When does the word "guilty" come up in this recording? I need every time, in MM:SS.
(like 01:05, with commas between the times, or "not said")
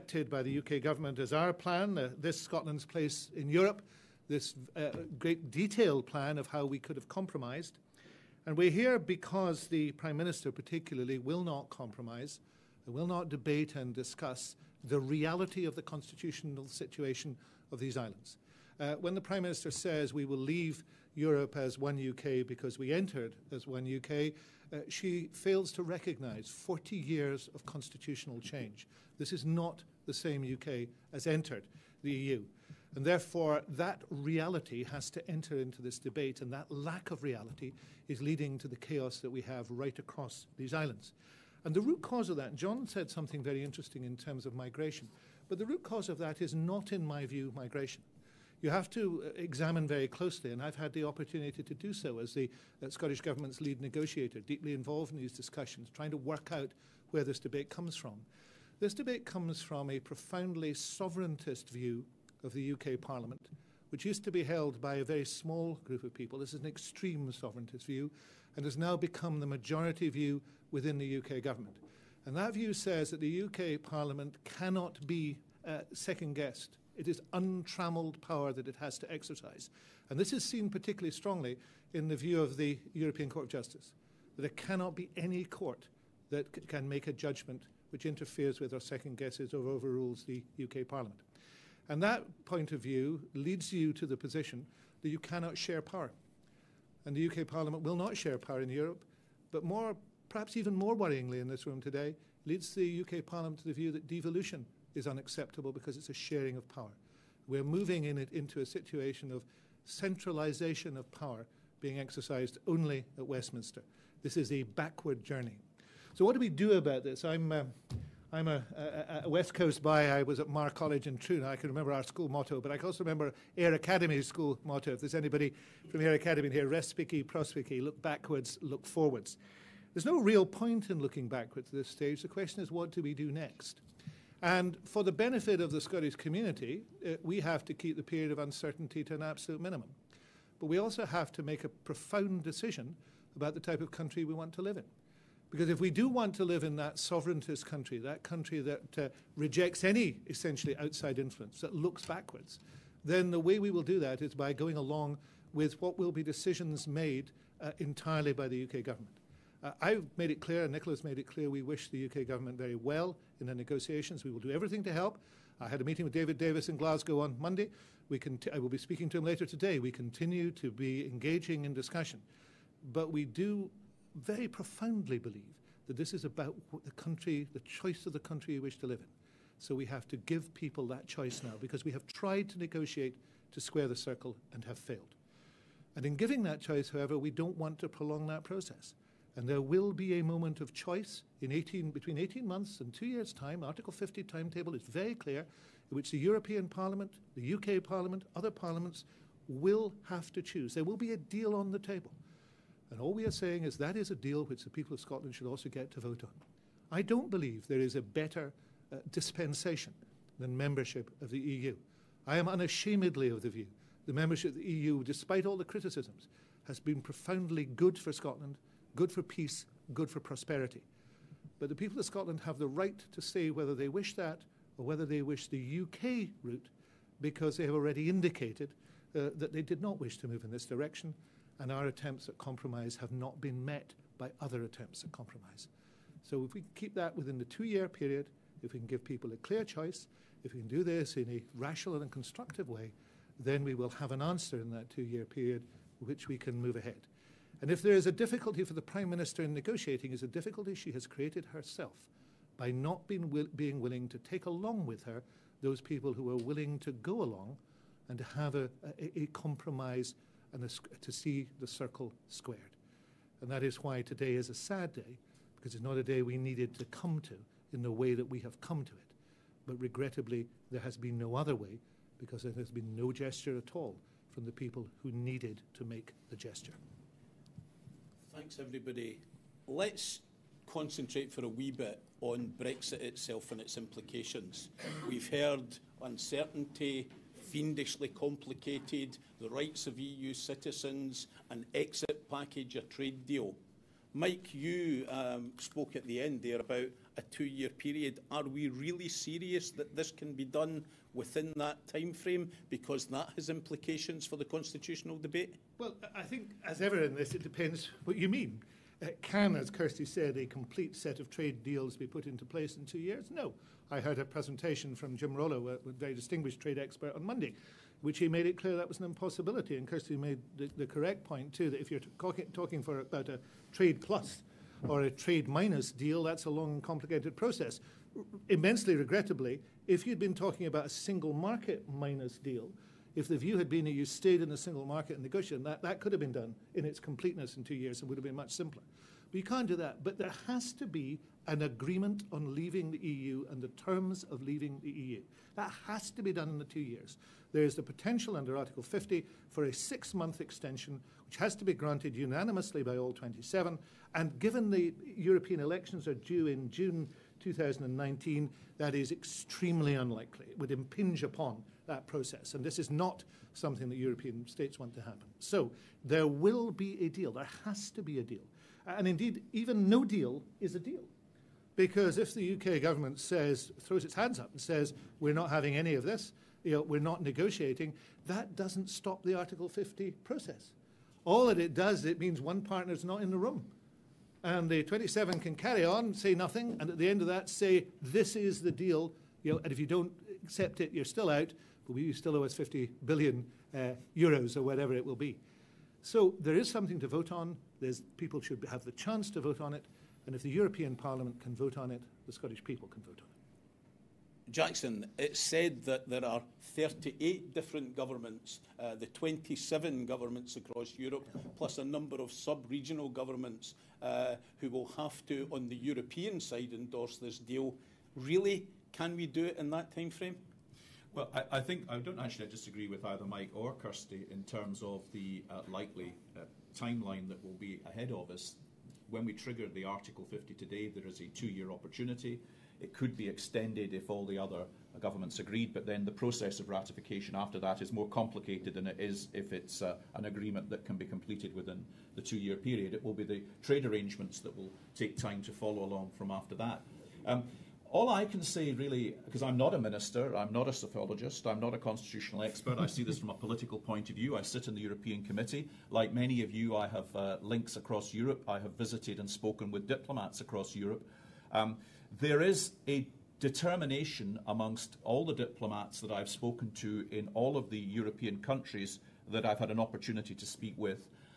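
not said.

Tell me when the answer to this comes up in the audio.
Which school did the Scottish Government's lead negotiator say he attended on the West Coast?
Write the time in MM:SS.
02:00.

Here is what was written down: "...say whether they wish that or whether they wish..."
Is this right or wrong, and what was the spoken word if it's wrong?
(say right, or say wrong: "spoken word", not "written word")
right.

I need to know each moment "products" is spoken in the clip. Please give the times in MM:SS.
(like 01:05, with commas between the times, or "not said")
not said.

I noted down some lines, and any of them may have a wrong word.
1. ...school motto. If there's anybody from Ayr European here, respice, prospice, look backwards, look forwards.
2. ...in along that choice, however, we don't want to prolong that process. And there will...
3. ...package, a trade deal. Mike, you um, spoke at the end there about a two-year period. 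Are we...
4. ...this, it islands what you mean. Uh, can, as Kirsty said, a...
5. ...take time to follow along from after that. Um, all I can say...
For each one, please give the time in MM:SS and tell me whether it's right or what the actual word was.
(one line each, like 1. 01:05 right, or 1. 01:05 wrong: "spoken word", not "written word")
1. 02:04 wrong: "Academy", not "European"
2. 03:06 wrong: "giving", not "along"
3. 04:52 right
4. 05:07 wrong: "depends", not "islands"
5. 07:24 right.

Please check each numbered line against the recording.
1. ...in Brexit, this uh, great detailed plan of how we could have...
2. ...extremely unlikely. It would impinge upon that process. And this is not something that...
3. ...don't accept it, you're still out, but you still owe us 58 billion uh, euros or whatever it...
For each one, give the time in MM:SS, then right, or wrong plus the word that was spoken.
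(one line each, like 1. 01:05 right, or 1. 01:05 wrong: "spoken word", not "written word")
1. 00:03 wrong: "Europe", not "Brexit"
2. 05:59 right
3. 06:29 wrong: "50", not "58".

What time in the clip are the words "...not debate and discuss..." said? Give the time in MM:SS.
00:13.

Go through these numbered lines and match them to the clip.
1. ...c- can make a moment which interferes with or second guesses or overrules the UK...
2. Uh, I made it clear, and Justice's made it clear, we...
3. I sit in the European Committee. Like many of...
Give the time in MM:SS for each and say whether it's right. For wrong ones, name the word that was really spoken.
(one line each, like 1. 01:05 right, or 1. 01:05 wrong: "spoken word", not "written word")
1. 01:26 wrong: "judgment", not "moment"
2. 02:39 wrong: "Nicola", not "Justice"
3. 07:34 right.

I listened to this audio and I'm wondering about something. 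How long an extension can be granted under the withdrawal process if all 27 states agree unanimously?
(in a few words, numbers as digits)
6 months.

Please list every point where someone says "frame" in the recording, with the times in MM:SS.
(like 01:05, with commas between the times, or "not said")
05:02, 07:00.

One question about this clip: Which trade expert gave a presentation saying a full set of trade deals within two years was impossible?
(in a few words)
Jim Rollo.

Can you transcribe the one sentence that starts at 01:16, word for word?
It is untrammeled power that it has to exercise.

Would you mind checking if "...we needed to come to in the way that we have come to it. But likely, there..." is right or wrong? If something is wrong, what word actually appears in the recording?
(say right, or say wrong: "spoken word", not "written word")
wrong: "regrettably", not "likely".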